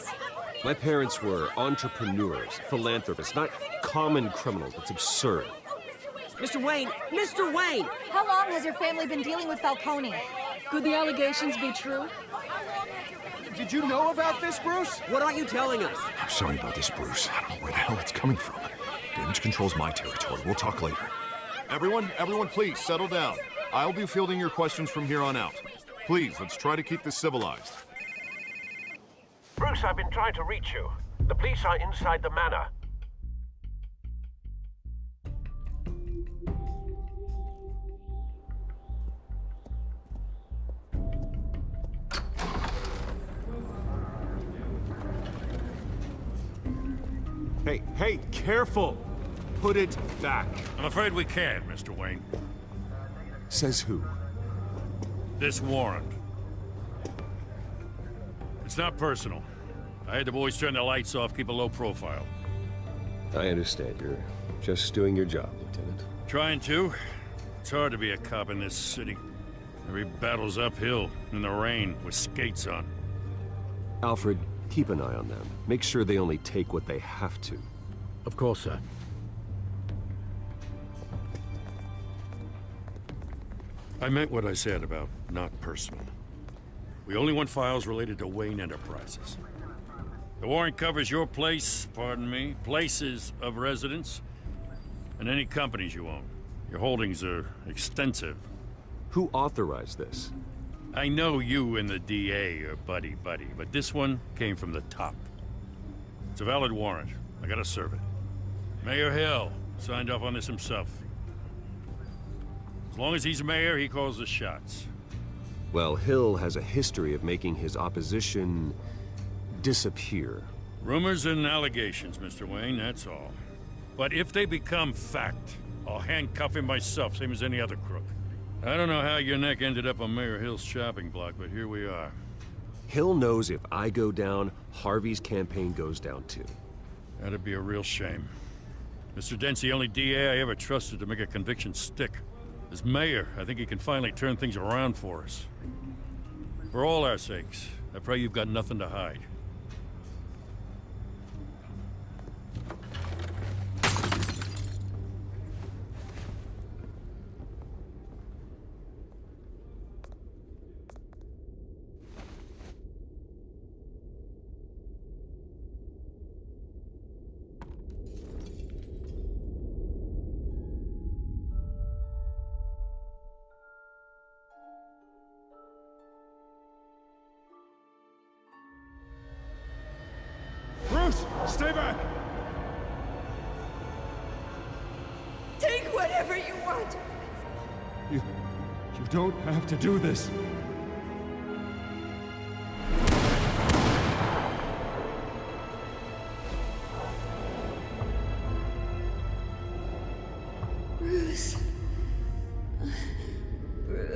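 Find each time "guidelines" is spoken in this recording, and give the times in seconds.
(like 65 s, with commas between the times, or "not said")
not said.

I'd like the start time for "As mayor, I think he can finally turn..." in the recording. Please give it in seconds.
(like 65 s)
142 s.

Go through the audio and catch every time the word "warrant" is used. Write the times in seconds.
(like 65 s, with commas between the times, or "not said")
55 s, 90 s, 106 s.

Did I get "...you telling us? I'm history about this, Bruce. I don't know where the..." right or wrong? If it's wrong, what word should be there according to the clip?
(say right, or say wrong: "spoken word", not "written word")
wrong: "sorry", not "history".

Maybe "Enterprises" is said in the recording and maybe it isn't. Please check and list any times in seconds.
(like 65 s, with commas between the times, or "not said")
88 s.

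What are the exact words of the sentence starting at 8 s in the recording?
How long has your family been dealing with Falcone?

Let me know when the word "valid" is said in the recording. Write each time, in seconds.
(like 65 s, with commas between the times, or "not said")
106 s.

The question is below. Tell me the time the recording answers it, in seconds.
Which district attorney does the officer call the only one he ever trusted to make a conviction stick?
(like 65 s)
139 s.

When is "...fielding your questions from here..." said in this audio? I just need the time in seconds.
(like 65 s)
24 s.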